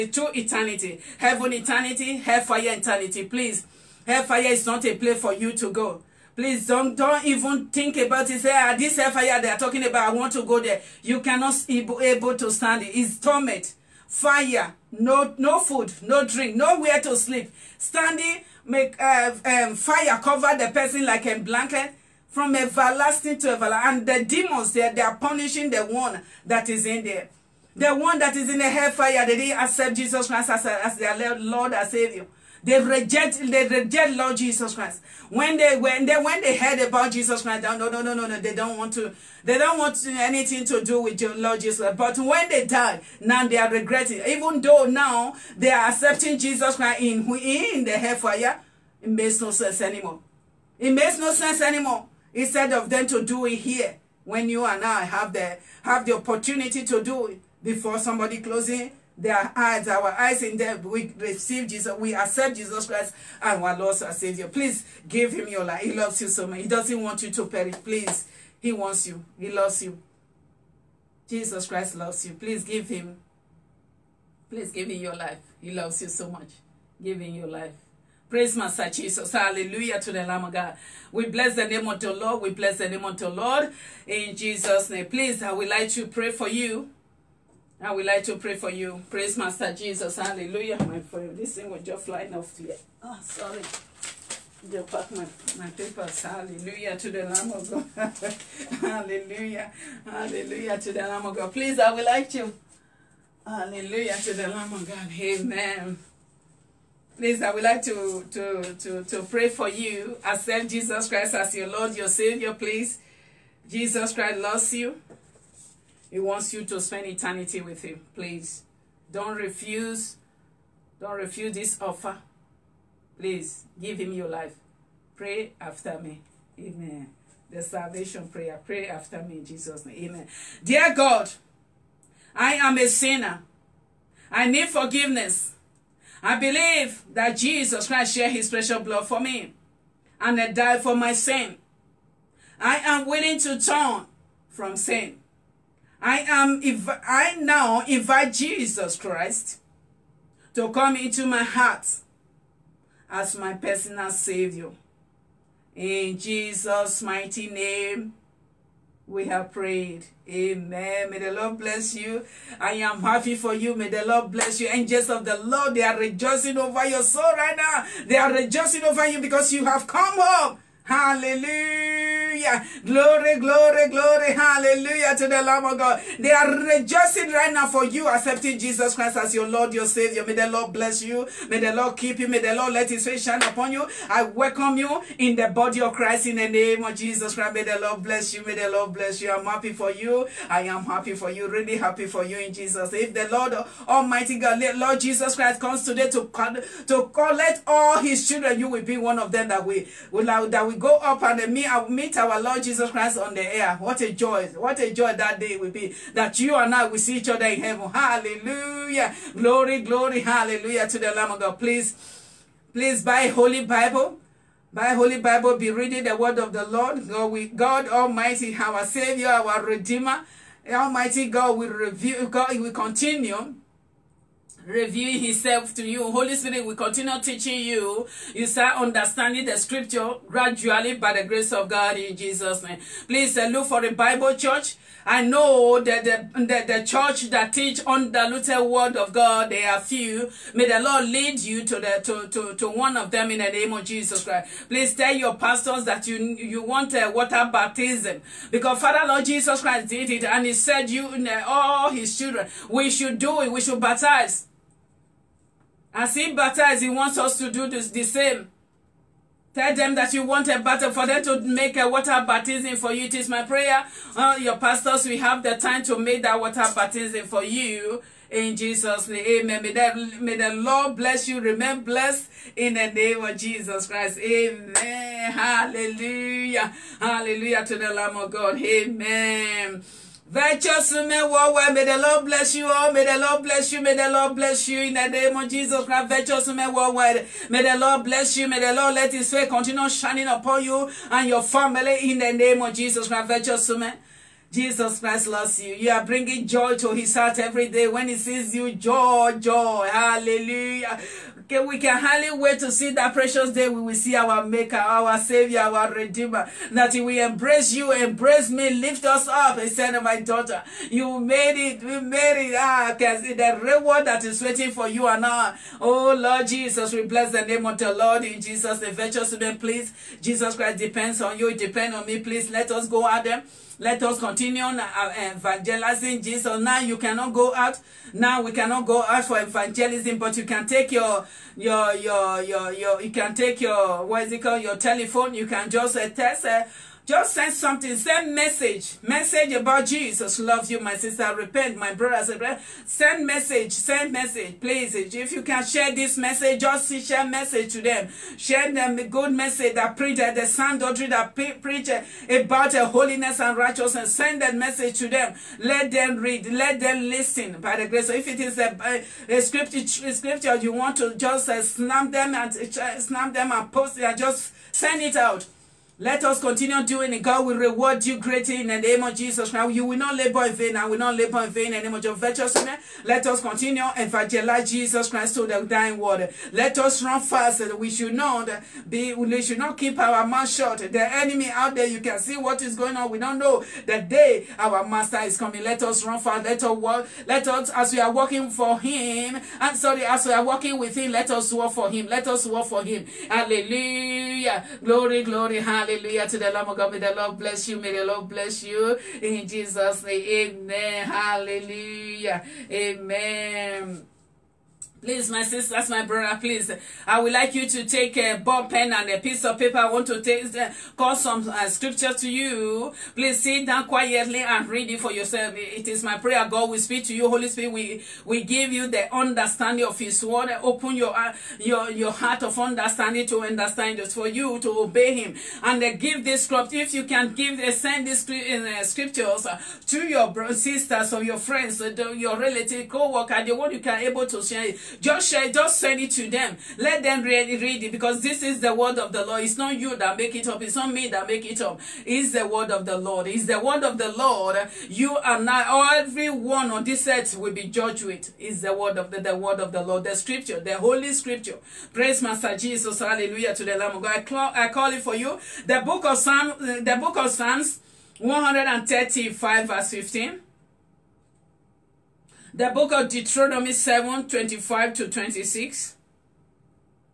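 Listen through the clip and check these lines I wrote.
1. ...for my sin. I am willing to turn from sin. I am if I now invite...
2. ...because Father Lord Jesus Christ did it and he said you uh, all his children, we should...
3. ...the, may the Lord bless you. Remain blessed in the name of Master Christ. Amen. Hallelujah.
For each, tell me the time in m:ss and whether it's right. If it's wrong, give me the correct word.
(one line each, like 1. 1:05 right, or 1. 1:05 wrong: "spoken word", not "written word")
1. 2:20 right
2. 4:08 right
3. 4:29 wrong: "Jesus", not "Master".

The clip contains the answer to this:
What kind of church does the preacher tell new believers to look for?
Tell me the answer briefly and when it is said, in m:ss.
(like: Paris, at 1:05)
a Bible church, at 3:53.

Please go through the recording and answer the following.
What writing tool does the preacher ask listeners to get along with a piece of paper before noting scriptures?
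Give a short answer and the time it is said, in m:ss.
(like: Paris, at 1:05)
ball pen, at 6:48.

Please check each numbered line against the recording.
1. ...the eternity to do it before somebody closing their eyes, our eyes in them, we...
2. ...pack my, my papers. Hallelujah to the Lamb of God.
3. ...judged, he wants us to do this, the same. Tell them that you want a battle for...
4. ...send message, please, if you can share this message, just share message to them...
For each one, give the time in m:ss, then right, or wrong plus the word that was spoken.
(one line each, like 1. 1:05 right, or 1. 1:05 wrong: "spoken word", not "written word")
1. 0:56 wrong: "opportunity", not "eternity"
2. 1:34 right
3. 4:16 wrong: "baptized", not "judged"
4. 5:43 right.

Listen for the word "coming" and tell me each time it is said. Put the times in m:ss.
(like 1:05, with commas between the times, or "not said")
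6:25.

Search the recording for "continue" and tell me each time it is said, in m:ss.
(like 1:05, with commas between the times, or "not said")
3:42, 3:46, 4:49, 5:24, 6:06, 6:13.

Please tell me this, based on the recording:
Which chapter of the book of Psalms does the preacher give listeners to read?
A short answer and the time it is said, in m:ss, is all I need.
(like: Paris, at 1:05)
135, at 7:38.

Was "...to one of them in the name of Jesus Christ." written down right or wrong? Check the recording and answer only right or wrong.
right.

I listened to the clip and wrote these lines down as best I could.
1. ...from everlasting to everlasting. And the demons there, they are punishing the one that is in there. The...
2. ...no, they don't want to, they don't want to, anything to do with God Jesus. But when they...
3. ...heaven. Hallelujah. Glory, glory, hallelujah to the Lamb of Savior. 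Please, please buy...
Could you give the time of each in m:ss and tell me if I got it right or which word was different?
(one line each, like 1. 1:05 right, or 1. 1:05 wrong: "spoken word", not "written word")
1. 0:22 right
2. 0:38 wrong: "Lord", not "God"
3. 3:27 wrong: "God", not "Savior".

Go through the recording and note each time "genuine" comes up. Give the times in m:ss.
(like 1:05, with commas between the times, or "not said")
not said.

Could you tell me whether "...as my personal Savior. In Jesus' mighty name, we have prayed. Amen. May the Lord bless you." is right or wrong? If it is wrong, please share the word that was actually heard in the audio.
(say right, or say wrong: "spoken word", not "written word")
right.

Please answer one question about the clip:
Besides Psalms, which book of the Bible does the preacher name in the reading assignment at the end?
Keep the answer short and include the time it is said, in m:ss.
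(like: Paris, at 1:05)
Deuteronomy, at 7:42.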